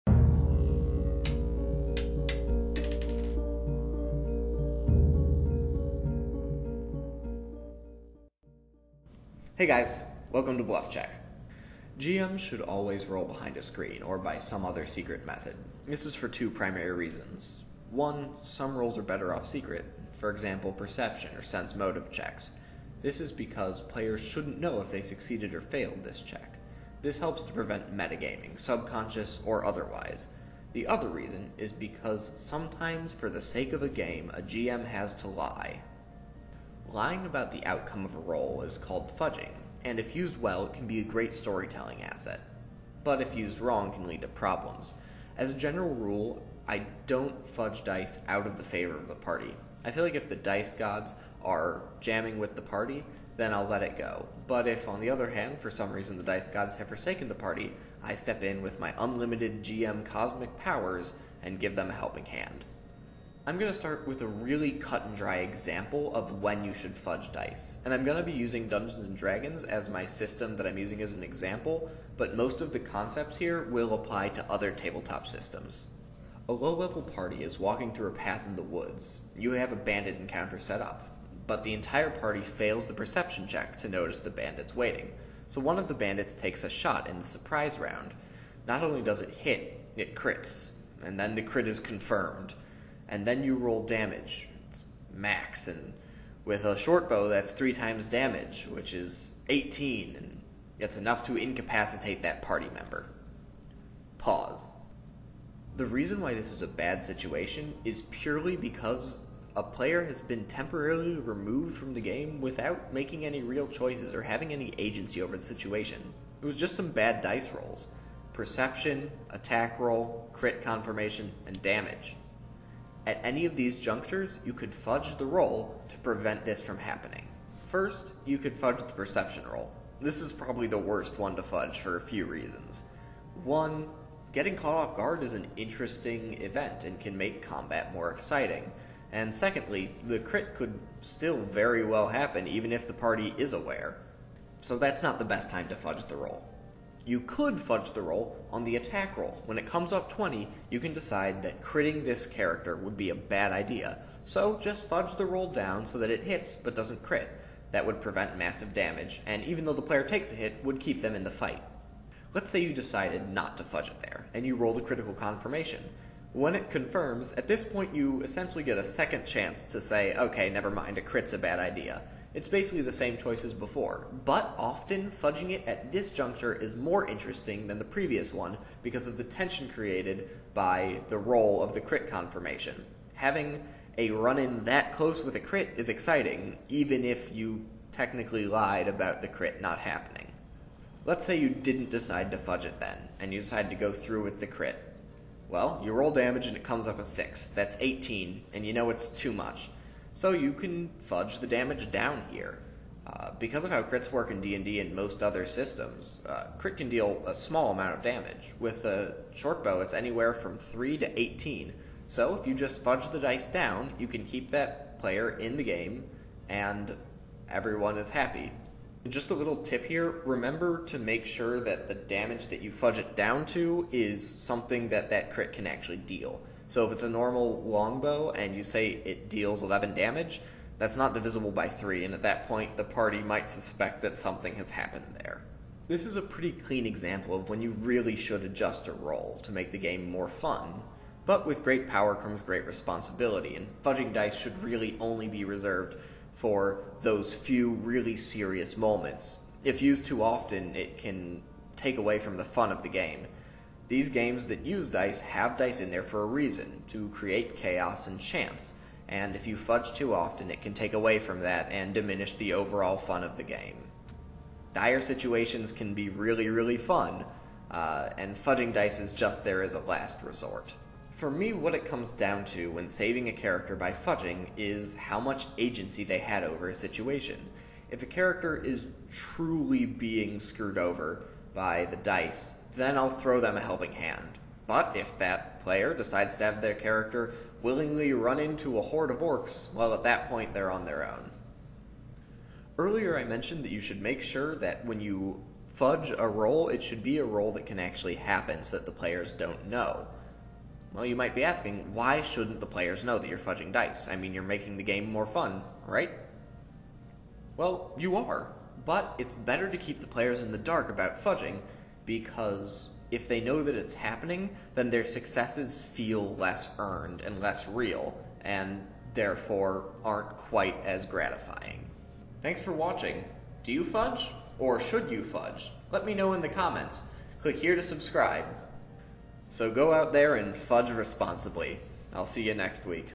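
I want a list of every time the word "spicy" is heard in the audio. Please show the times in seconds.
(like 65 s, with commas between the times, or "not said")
not said.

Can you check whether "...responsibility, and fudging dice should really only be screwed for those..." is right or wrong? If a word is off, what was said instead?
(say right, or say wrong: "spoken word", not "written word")
wrong: "reserved", not "screwed".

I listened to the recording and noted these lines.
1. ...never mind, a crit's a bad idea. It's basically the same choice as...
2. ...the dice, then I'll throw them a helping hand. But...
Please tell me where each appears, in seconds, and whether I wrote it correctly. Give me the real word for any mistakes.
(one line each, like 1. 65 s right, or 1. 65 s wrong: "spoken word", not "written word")
1. 170 s right
2. 281 s right.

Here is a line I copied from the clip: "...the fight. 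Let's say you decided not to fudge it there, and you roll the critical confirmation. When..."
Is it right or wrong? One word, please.
right.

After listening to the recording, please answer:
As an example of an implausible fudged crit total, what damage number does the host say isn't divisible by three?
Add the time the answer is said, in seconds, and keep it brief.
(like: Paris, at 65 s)
11, at 229 s.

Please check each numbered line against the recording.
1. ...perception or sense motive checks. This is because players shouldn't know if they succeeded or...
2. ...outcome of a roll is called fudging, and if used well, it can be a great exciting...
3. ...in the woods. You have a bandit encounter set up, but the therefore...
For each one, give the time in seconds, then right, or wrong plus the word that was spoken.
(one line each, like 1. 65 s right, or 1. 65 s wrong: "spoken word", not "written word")
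1. 20 s right
2. 37 s wrong: "storytelling", not "exciting"
3. 78 s wrong: "entire", not "therefore".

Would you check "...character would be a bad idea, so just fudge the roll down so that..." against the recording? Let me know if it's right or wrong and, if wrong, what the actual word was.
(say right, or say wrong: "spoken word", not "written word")
right.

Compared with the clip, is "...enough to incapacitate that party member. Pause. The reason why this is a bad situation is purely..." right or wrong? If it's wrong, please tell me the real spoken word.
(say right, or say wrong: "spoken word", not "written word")
right.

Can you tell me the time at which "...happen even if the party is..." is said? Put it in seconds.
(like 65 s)
142 s.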